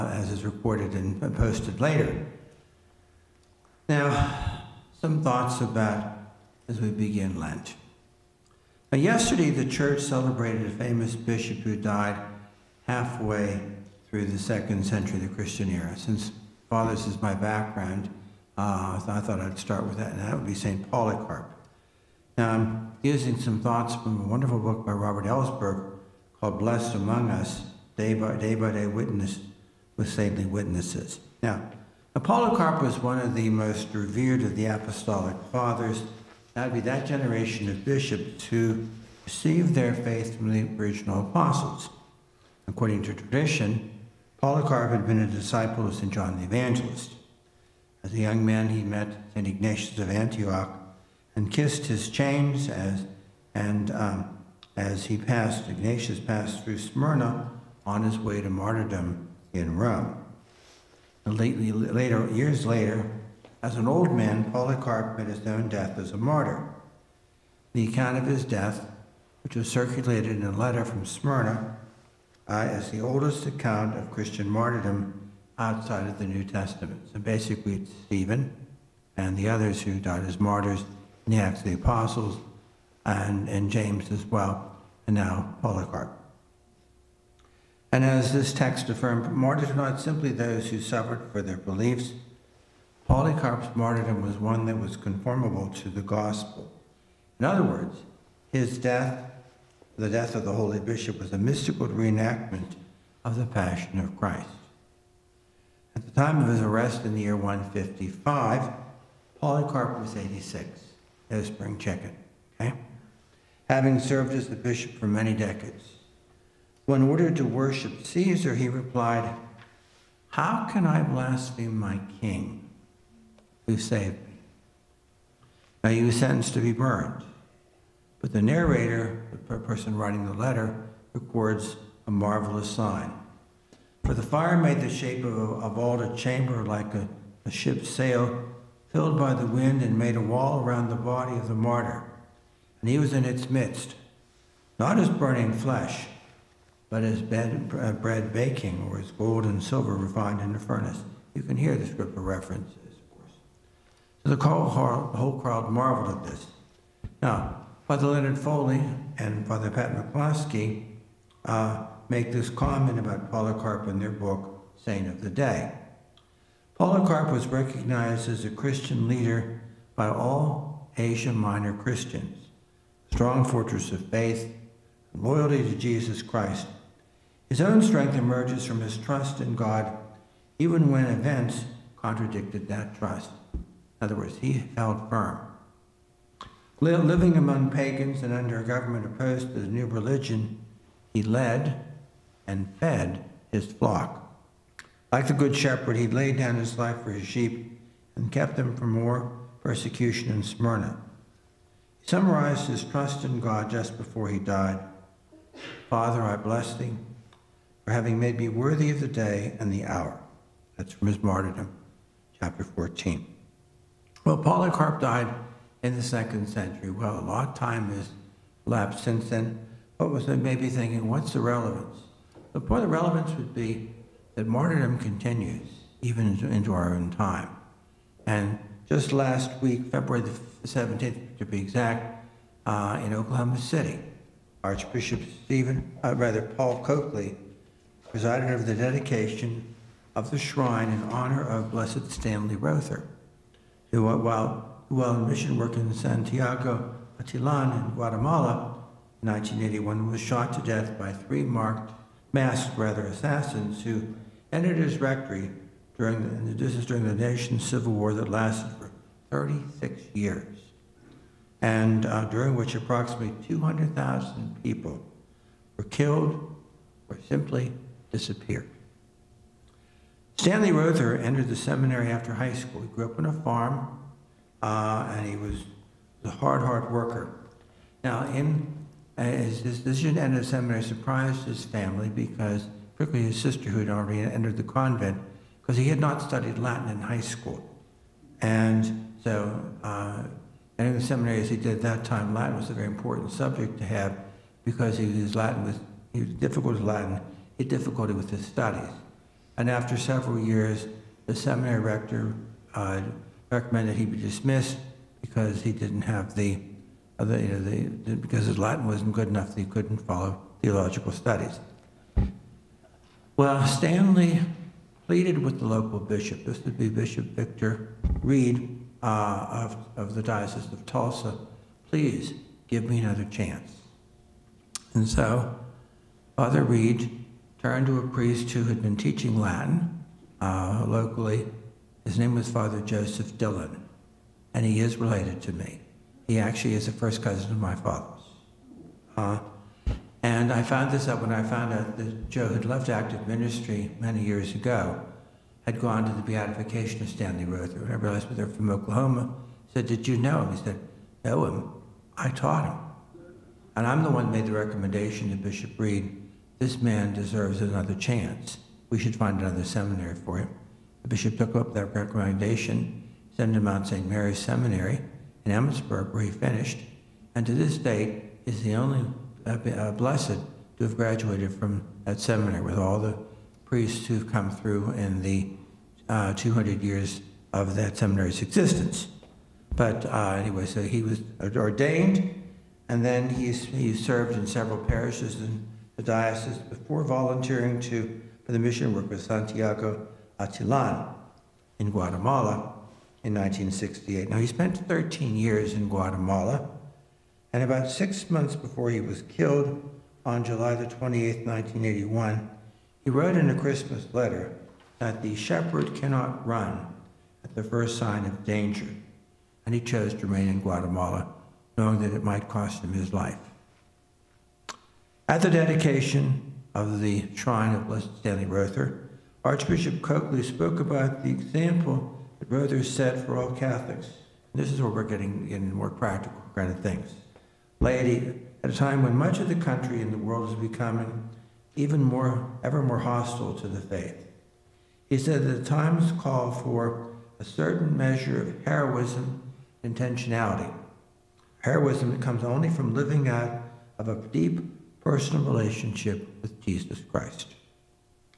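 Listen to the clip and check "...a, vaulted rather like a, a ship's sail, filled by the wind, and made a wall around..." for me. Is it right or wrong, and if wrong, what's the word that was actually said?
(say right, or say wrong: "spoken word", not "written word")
wrong: "chamber", not "rather".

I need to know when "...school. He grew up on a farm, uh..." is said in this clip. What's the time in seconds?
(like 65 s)
272 s.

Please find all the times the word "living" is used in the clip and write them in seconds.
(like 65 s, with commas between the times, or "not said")
186 s, 442 s.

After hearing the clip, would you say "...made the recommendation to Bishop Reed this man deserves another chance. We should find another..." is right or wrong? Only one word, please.
right.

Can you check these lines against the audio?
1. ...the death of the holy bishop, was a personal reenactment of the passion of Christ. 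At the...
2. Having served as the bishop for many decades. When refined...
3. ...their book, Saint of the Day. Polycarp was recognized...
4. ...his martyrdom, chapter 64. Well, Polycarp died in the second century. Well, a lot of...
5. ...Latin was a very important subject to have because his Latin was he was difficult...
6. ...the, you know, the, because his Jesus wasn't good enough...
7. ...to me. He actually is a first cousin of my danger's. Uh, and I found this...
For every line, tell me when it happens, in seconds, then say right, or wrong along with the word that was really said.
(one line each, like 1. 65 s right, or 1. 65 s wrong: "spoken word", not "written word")
1. 99 s wrong: "mystical", not "personal"
2. 113 s wrong: "ordered", not "refined"
3. 163 s right
4. 211 s wrong: "14", not "64"
5. 292 s right
6. 307 s wrong: "Latin", not "Jesus"
7. 335 s wrong: "father", not "danger".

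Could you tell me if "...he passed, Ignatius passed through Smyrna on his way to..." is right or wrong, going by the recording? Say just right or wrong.
right.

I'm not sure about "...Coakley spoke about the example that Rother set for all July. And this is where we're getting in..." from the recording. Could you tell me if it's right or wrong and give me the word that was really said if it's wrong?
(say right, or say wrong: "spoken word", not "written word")
wrong: "Catholics", not "July".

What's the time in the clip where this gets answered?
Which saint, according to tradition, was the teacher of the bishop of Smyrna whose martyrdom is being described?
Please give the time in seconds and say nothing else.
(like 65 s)
45 s.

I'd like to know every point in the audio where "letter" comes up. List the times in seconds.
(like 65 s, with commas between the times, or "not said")
70 s, 130 s, 404 s.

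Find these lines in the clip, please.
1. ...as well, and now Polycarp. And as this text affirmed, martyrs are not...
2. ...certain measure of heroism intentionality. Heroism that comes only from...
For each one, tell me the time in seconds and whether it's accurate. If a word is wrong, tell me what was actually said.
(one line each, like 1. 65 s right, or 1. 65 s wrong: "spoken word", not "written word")
1. 84 s right
2. 437 s right.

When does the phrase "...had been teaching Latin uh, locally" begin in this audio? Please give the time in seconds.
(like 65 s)
328 s.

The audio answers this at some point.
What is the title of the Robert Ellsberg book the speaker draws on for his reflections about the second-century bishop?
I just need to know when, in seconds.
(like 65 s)
26 s.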